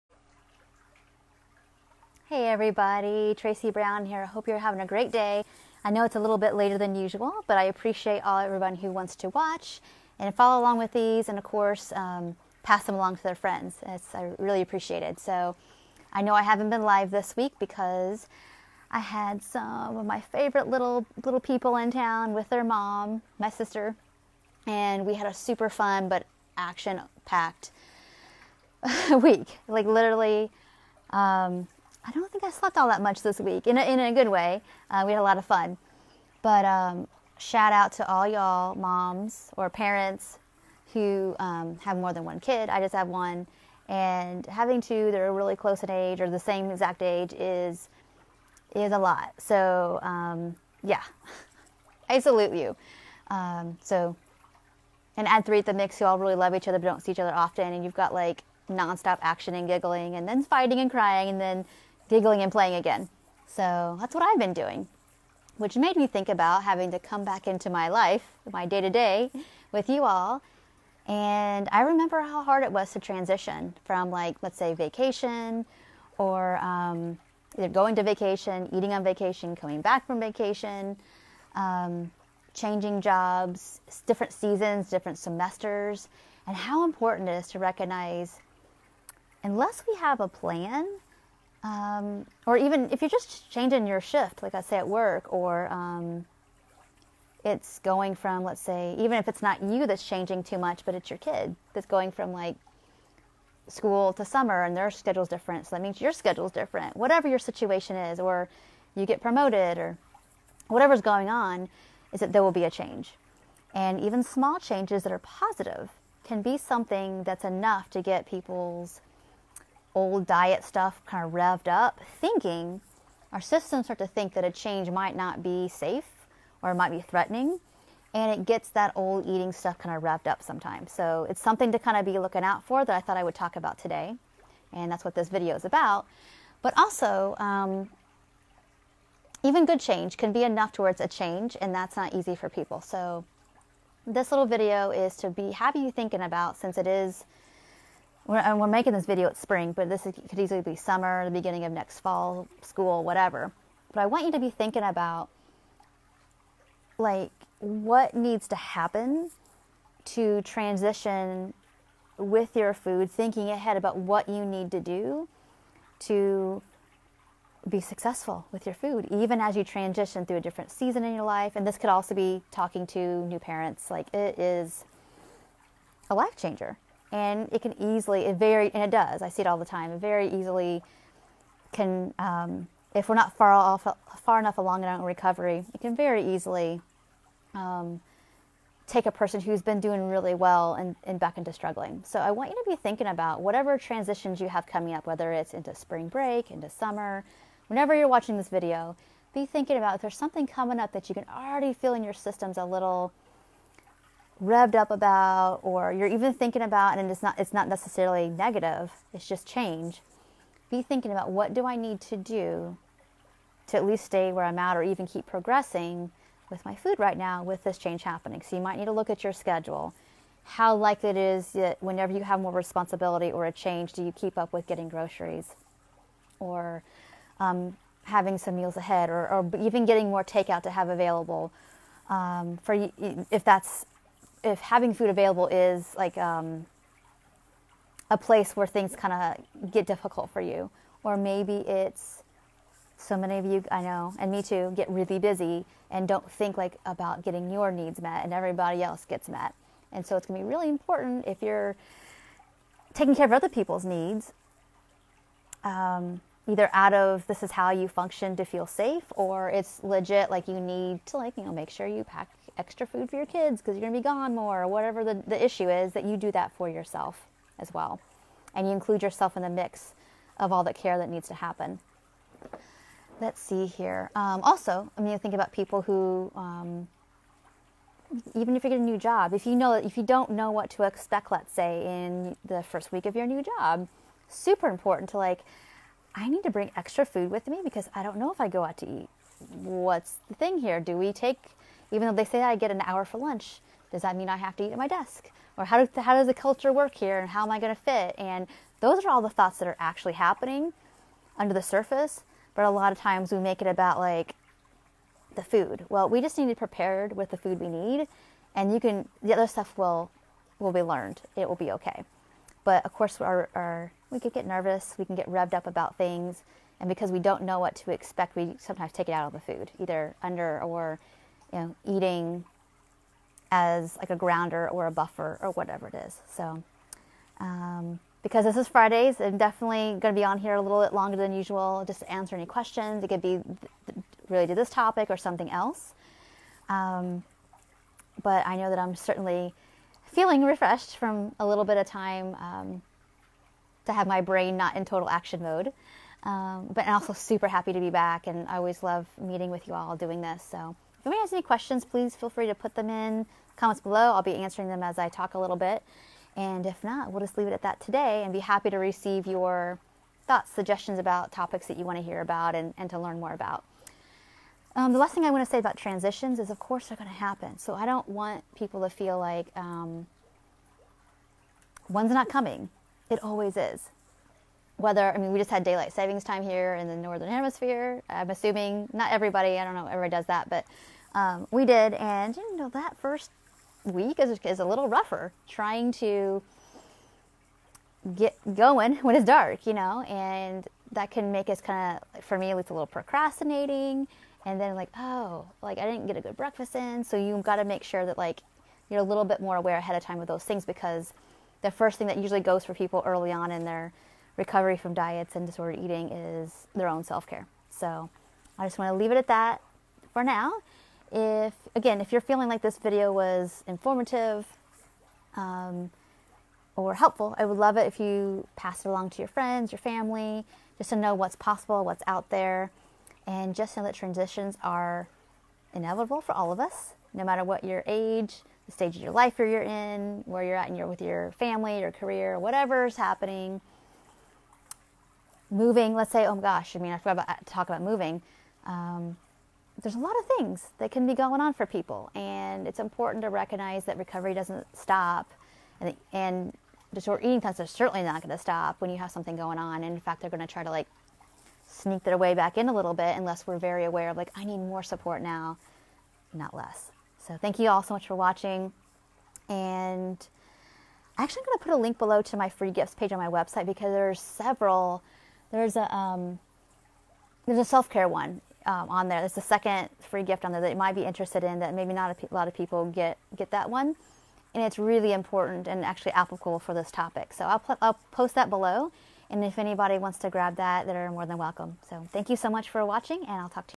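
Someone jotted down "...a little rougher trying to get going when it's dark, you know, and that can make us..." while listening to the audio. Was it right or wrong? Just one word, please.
right.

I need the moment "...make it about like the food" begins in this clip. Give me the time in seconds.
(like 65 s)
303 s.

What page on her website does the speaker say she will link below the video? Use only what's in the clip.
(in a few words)
free gifts page.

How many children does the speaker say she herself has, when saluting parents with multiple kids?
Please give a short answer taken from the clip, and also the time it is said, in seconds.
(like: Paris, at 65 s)
1, at 42 s.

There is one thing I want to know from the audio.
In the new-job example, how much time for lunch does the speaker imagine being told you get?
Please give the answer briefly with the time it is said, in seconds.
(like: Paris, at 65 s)
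an hour, at 292 s.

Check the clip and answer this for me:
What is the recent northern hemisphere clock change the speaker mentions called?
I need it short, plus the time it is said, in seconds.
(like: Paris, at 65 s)
daylight savings time, at 375 s.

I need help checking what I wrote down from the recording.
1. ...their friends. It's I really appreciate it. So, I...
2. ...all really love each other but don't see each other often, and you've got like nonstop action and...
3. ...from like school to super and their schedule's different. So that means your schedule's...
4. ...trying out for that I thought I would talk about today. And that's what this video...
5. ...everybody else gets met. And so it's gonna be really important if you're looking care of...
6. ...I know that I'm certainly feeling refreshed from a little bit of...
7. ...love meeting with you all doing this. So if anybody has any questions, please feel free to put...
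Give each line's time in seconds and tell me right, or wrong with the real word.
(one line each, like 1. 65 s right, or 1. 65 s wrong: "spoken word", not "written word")
1. 13 s right
2. 56 s right
3. 102 s wrong: "summer", not "super"
4. 132 s wrong: "looking", not "trying"
5. 248 s wrong: "taking", not "looking"
6. 338 s right
7. 348 s right.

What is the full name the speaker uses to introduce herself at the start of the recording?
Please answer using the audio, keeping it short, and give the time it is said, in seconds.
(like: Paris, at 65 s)
Tracy Brown, at 3 s.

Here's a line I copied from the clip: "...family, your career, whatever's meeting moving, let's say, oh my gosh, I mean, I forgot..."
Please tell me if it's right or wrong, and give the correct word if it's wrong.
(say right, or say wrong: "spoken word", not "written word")
wrong: "happening", not "meeting".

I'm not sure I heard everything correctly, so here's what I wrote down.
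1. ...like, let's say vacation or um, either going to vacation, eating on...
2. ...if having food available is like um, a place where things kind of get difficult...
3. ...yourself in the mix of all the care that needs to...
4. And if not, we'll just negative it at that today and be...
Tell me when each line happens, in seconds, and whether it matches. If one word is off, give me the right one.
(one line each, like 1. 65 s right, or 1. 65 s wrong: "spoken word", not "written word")
1. 74 s right
2. 234 s right
3. 269 s right
4. 356 s wrong: "leave", not "negative".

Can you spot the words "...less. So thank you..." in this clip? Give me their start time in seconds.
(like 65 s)
456 s.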